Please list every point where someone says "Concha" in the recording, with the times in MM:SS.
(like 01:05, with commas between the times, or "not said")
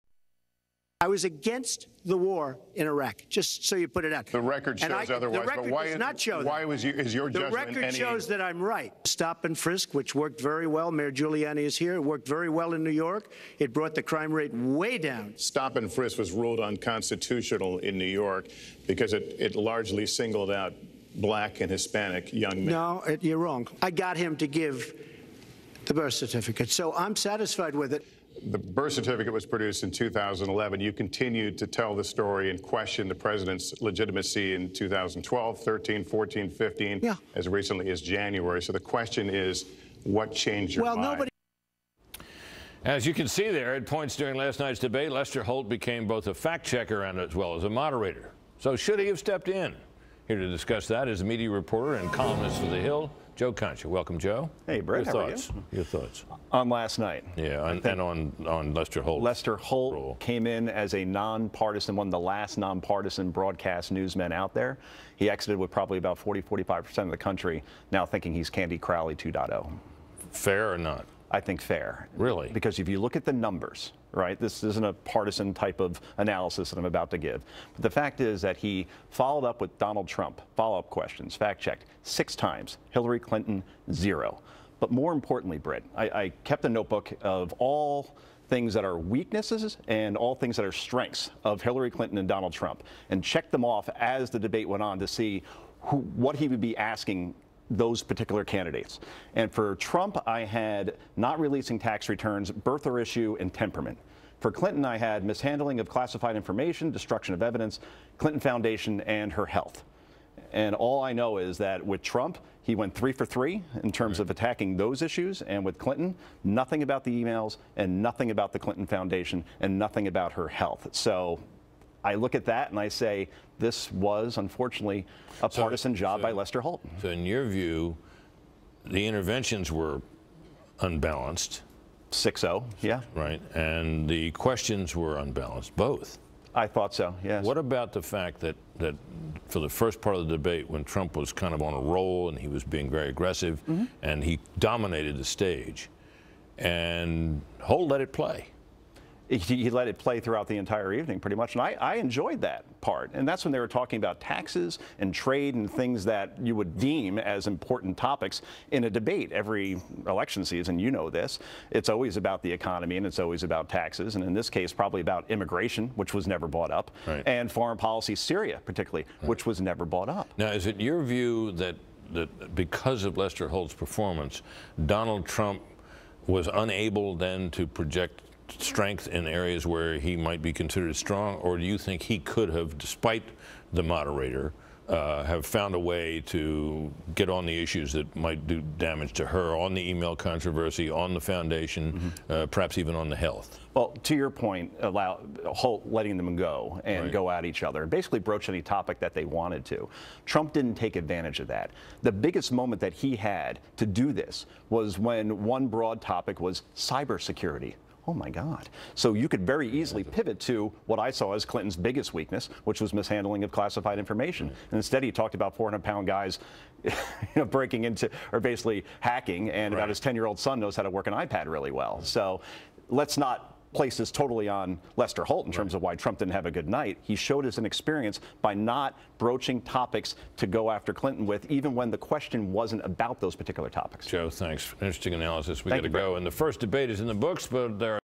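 00:53.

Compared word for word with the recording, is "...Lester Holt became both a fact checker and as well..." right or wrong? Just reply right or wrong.
right.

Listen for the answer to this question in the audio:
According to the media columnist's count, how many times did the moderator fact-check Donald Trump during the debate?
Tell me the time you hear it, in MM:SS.
01:22.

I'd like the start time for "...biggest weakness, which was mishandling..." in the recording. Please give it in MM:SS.
03:31.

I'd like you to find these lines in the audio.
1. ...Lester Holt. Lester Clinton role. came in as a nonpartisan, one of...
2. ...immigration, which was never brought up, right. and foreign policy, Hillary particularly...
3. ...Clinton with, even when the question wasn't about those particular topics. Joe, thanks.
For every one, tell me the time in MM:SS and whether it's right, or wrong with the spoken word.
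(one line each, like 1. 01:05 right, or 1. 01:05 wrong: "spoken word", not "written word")
1. 00:58 wrong: "Holt", not "Clinton"
2. 02:45 wrong: "Syria", not "Hillary"
3. 03:50 right.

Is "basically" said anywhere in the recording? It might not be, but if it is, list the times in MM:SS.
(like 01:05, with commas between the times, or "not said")
03:17, 03:38.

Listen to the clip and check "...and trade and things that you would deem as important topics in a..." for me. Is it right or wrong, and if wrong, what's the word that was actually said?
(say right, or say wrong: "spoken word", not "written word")
right.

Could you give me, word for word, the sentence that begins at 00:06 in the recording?
was you, is your the judgment The record any...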